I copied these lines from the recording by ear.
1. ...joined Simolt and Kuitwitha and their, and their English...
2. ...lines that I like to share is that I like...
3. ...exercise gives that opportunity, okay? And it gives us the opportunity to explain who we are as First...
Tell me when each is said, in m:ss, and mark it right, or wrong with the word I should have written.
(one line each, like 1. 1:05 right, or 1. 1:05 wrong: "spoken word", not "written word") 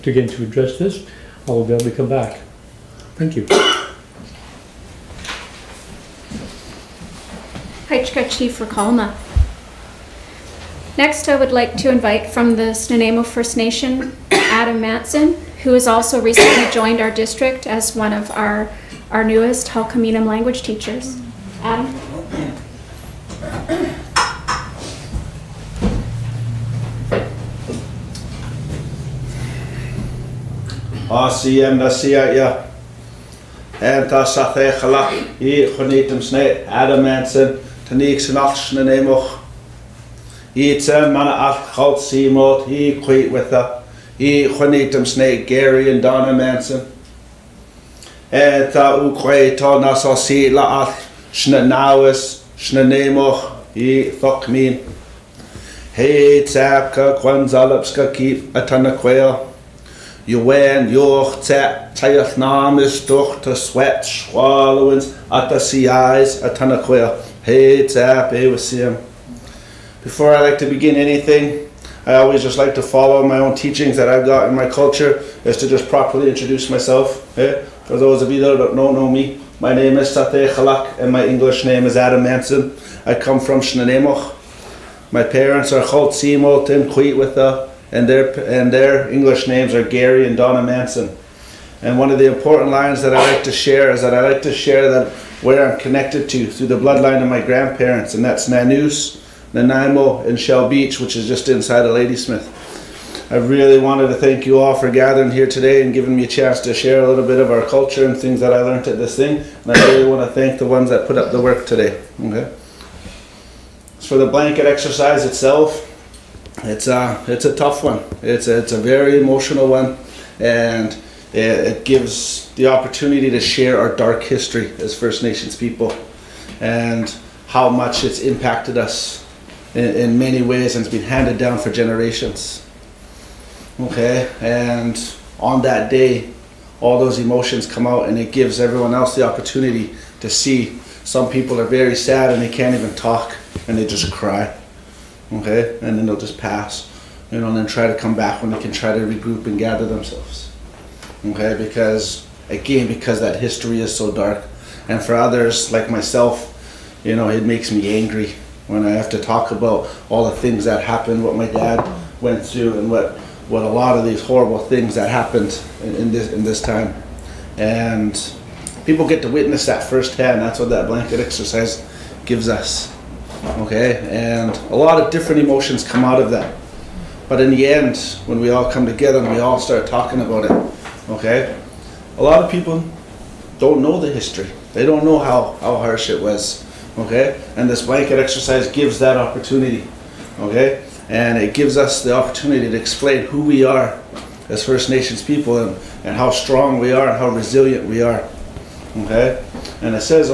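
1. 1:25 wrong: "called", not "joined"
2. 1:32 right
3. 3:08 right.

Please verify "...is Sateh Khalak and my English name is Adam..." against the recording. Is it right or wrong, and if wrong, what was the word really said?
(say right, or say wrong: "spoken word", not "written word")
right.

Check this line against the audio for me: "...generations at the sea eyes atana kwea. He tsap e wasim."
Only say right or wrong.
wrong.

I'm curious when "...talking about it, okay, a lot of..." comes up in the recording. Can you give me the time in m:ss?
2:59.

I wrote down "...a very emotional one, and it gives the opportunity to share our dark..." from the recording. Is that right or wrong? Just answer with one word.
right.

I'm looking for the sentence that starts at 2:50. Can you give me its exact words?
That's what that blanket exercise gives us.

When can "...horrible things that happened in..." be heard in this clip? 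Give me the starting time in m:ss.
2:44.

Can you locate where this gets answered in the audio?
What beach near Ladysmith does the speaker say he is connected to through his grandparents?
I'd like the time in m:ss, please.
1:40.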